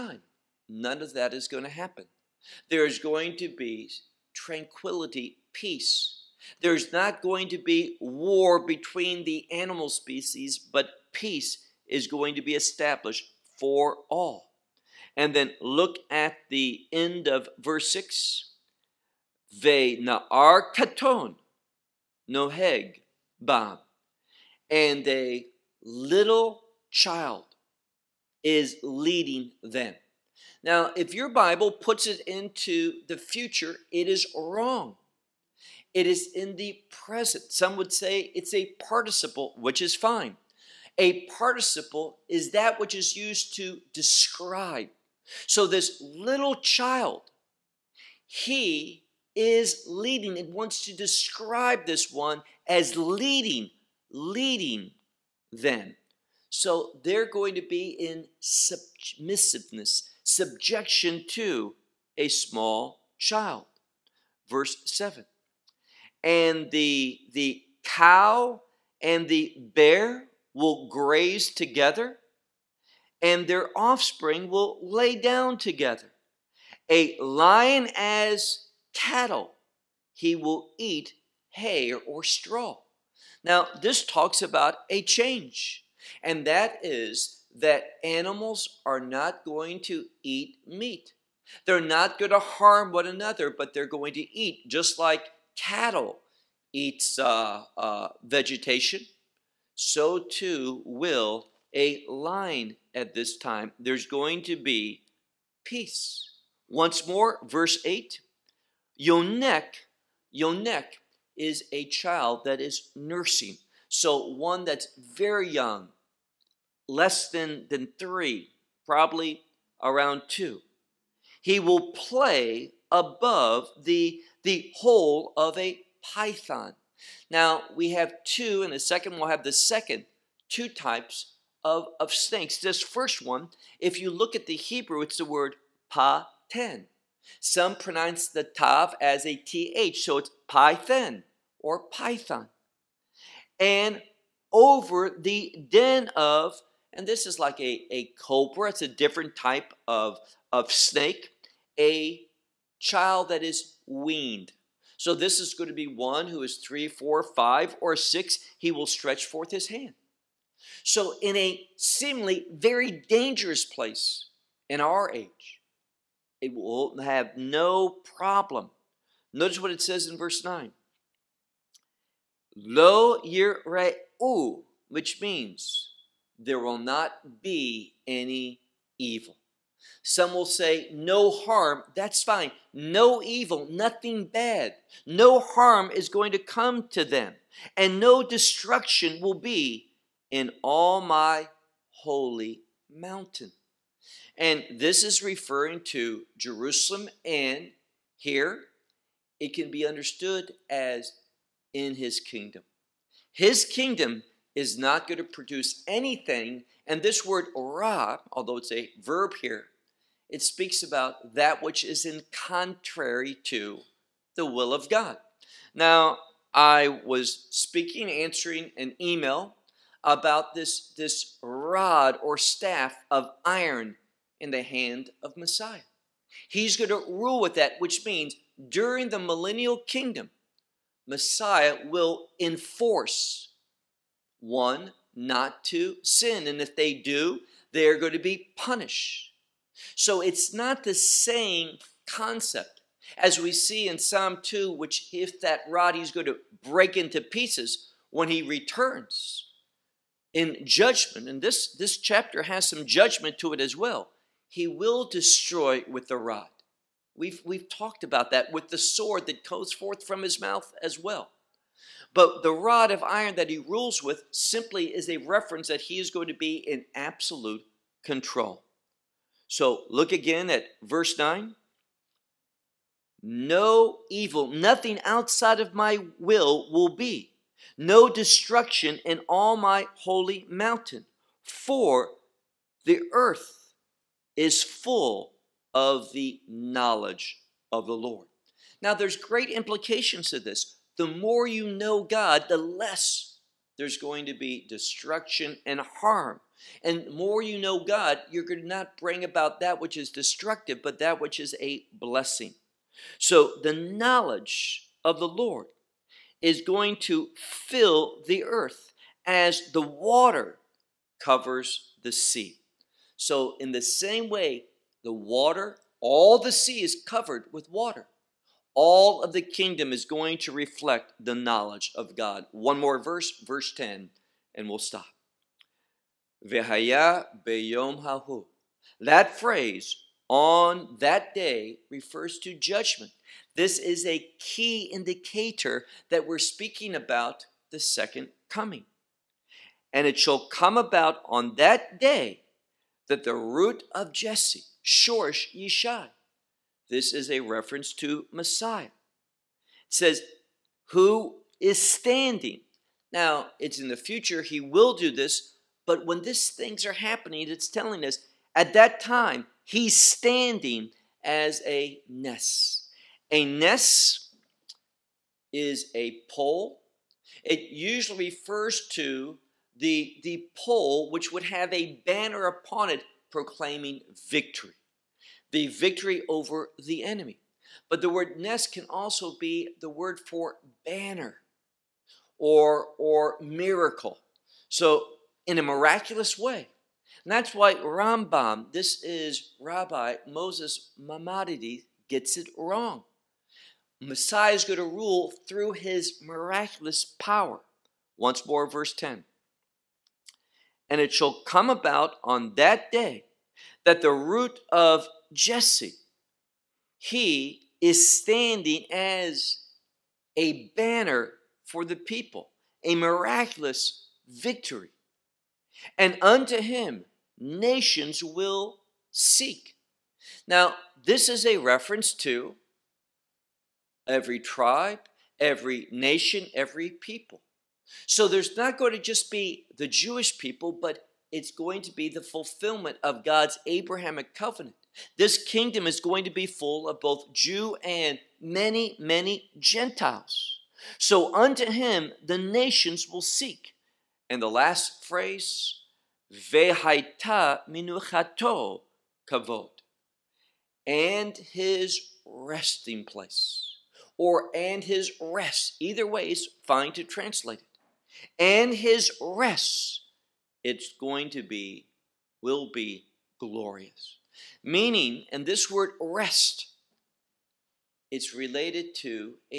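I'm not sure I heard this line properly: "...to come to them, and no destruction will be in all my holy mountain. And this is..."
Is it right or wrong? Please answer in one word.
right.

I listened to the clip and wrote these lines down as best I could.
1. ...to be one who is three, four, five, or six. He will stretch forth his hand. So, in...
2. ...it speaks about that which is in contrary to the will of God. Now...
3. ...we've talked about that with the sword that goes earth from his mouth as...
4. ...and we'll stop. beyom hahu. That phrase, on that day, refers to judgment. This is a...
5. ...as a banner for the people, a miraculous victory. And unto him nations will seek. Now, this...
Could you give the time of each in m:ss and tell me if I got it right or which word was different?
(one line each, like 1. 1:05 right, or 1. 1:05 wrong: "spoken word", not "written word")
1. 2:35 right
2. 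3:30 right
3. 4:17 wrong: "forth", not "earth"
4. 5:24 right
5. 6:48 right.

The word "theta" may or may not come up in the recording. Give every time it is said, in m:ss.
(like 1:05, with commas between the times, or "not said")
not said.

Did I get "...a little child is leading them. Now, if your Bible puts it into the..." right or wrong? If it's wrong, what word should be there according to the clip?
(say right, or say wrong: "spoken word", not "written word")
right.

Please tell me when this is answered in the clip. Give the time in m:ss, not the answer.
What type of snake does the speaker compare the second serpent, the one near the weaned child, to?
2:28.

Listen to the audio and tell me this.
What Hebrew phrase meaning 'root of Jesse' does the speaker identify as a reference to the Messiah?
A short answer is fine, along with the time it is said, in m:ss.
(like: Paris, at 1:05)
Shorsh Yishai, at 5:44.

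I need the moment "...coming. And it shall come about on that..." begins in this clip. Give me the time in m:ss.
5:38.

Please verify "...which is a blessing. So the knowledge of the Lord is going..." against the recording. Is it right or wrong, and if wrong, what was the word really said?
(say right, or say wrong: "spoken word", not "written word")
right.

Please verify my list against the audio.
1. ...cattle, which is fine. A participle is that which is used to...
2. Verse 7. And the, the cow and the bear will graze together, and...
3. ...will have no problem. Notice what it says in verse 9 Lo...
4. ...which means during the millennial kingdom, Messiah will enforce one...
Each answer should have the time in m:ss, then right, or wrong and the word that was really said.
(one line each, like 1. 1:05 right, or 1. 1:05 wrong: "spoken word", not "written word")
1. 0:38 wrong: "participle", not "cattle"
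2. 1:04 right
3. 2:46 right
4. 3:47 right.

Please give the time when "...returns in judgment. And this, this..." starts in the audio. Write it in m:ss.
4:08.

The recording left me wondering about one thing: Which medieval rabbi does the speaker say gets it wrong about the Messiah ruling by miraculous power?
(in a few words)
Maimonides.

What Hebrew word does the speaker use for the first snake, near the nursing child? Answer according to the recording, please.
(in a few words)
pa-ten.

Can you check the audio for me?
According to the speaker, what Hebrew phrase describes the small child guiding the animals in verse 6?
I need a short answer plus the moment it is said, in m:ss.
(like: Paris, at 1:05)
Ve na'ar katon noheg bam, at 0:19.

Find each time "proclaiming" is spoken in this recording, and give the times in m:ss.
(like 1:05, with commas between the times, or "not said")
6:13.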